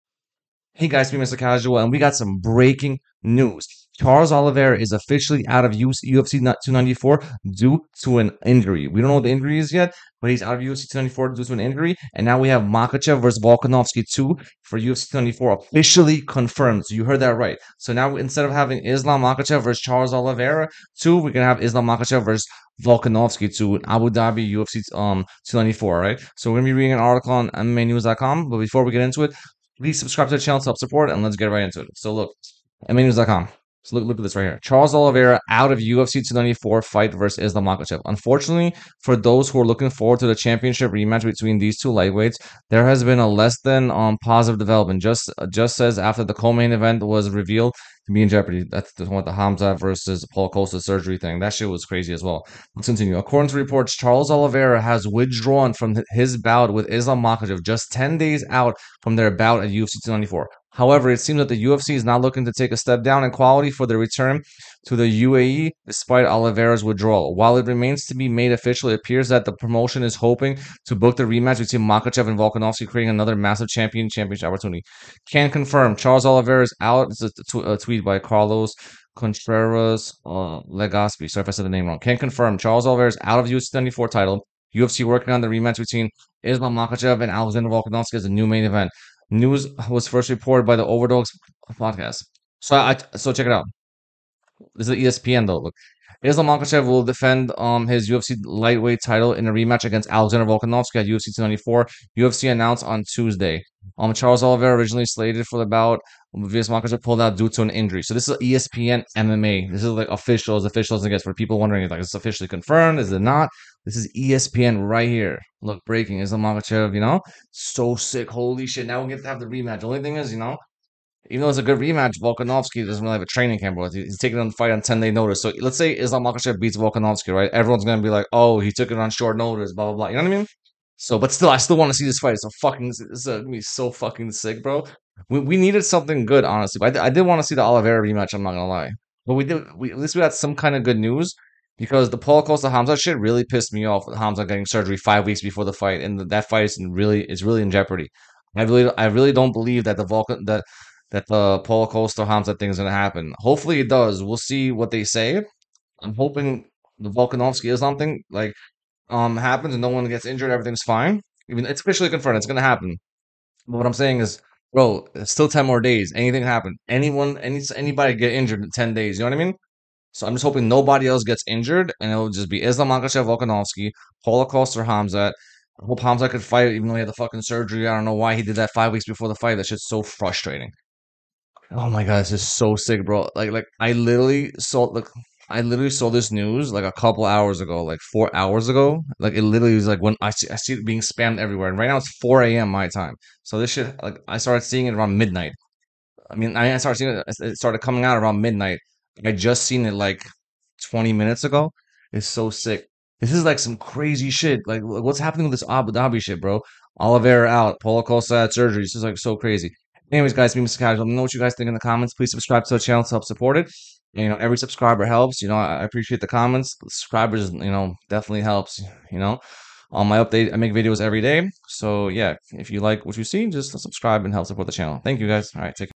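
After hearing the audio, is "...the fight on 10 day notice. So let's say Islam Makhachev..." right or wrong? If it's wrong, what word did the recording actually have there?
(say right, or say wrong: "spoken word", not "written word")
right.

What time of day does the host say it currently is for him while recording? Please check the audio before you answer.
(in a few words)
4 a.m.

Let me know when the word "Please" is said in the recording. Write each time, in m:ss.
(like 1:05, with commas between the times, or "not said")
0:29, 3:32.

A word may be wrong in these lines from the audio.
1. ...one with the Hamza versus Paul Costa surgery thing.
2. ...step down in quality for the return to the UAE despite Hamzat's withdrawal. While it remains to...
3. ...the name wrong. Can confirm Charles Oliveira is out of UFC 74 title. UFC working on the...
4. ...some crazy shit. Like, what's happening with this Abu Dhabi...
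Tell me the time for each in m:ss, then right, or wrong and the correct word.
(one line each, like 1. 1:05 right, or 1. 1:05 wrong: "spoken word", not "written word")
1. 0:49 right
2. 1:02 wrong: "Oliveira", not "Hamzat"
3. 1:21 right
4. 3:23 right.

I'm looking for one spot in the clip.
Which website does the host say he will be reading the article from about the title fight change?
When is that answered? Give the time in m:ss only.
0:27.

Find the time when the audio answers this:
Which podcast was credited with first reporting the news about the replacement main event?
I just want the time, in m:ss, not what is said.
1:30.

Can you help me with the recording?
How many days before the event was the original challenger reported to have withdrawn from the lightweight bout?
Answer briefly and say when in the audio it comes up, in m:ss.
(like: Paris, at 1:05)
10, at 0:57.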